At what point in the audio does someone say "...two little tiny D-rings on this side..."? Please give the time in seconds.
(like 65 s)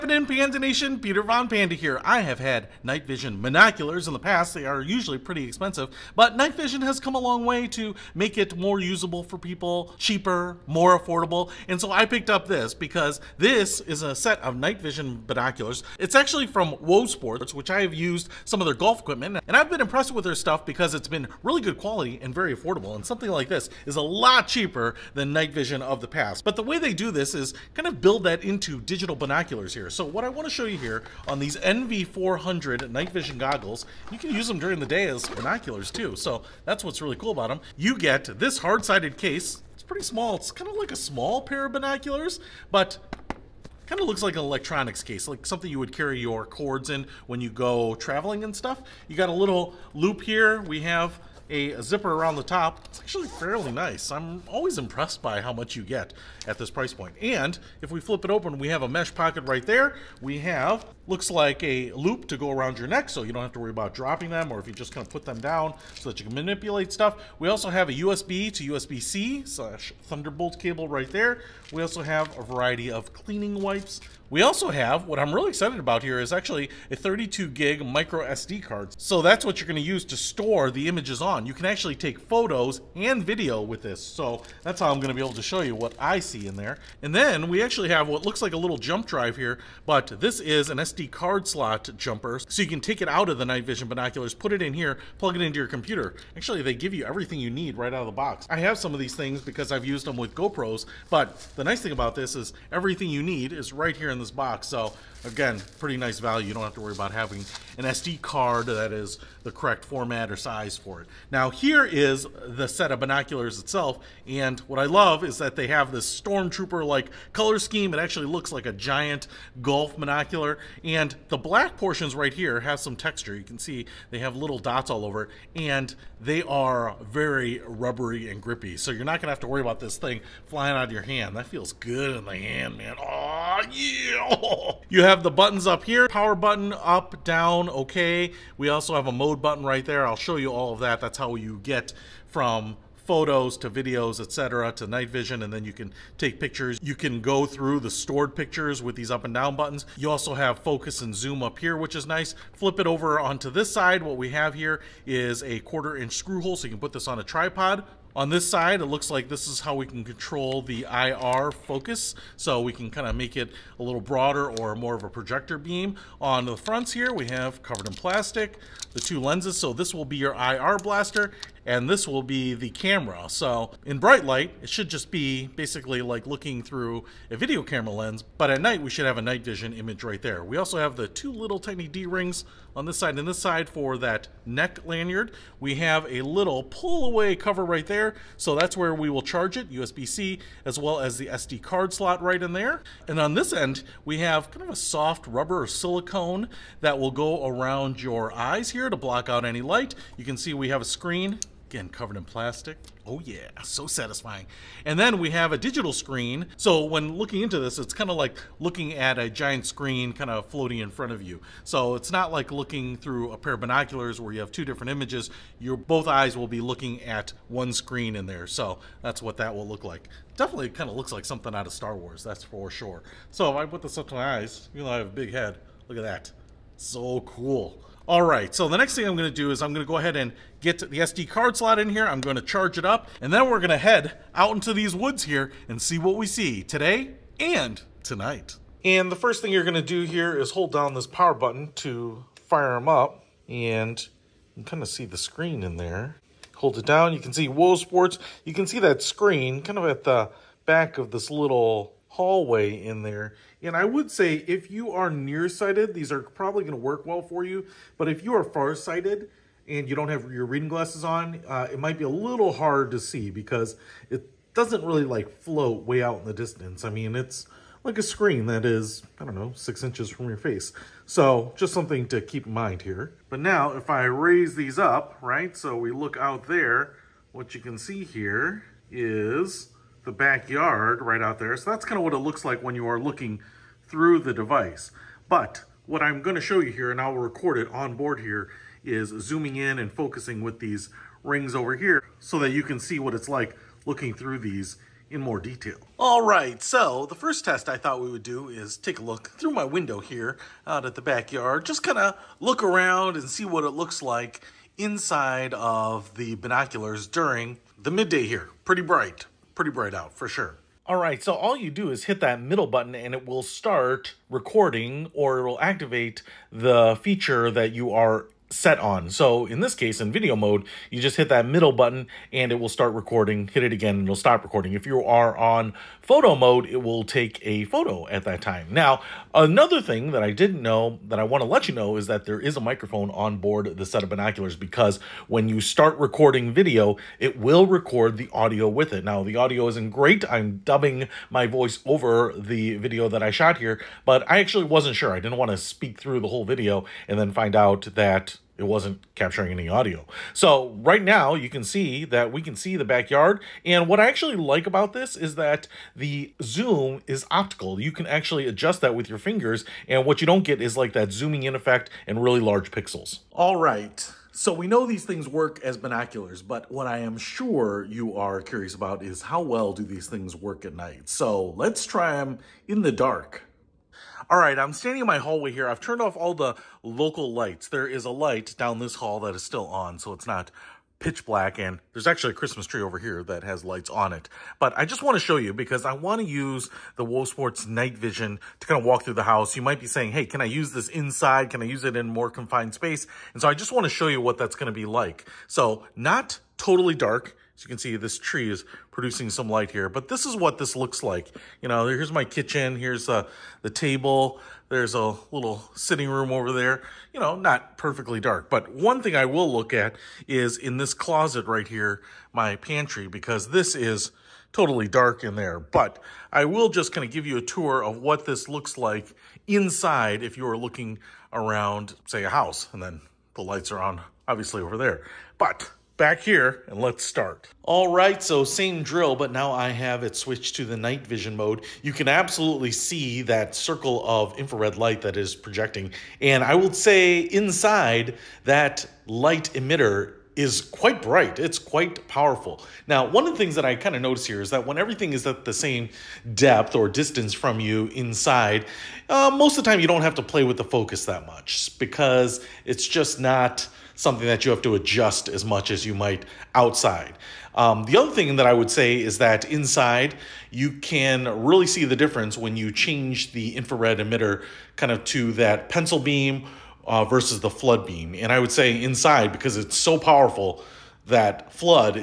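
181 s.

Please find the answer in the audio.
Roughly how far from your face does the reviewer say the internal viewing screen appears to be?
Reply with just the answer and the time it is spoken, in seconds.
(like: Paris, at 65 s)
6 inches, at 269 s.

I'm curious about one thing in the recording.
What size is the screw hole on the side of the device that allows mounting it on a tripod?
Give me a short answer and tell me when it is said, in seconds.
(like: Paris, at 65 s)
Quarter inch, at 155 s.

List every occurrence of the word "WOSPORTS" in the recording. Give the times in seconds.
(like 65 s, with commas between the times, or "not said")
16 s, 247 s, 387 s.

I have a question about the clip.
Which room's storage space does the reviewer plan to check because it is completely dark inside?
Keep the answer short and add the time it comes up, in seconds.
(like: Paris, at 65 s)
Pantry, at 412 s.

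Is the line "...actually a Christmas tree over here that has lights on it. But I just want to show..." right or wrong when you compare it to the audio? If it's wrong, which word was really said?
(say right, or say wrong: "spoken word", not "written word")
right.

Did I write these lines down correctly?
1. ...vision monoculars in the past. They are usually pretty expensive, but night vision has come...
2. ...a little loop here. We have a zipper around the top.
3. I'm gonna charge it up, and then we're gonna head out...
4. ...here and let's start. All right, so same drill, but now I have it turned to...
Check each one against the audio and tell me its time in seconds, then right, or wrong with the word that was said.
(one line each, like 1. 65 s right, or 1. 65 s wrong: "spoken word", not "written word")
1. 3 s right
2. 49 s right
3. 232 s right
4. 426 s wrong: "switched", not "turned".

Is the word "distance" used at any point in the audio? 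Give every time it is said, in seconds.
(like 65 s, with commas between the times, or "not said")
266 s, 446 s.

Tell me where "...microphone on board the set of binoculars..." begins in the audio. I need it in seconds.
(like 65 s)
332 s.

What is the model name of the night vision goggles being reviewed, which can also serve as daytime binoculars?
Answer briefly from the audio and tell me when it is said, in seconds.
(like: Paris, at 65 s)
NV400, at 31 s.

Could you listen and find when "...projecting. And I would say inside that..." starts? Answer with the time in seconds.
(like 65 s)
435 s.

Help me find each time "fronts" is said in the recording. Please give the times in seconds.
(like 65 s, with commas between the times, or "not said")
166 s, 210 s.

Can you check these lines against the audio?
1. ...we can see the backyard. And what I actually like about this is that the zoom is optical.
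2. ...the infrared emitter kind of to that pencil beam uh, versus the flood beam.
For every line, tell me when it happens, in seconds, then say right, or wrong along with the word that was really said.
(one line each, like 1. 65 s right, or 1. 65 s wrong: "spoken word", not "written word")
1. 352 s right
2. 463 s right.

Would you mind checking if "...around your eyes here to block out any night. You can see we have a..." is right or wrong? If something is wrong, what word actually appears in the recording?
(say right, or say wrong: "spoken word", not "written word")
wrong: "light", not "night".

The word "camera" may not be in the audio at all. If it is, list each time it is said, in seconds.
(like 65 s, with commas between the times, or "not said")
172 s, 177 s.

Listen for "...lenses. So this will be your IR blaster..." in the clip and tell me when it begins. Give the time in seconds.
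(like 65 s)
169 s.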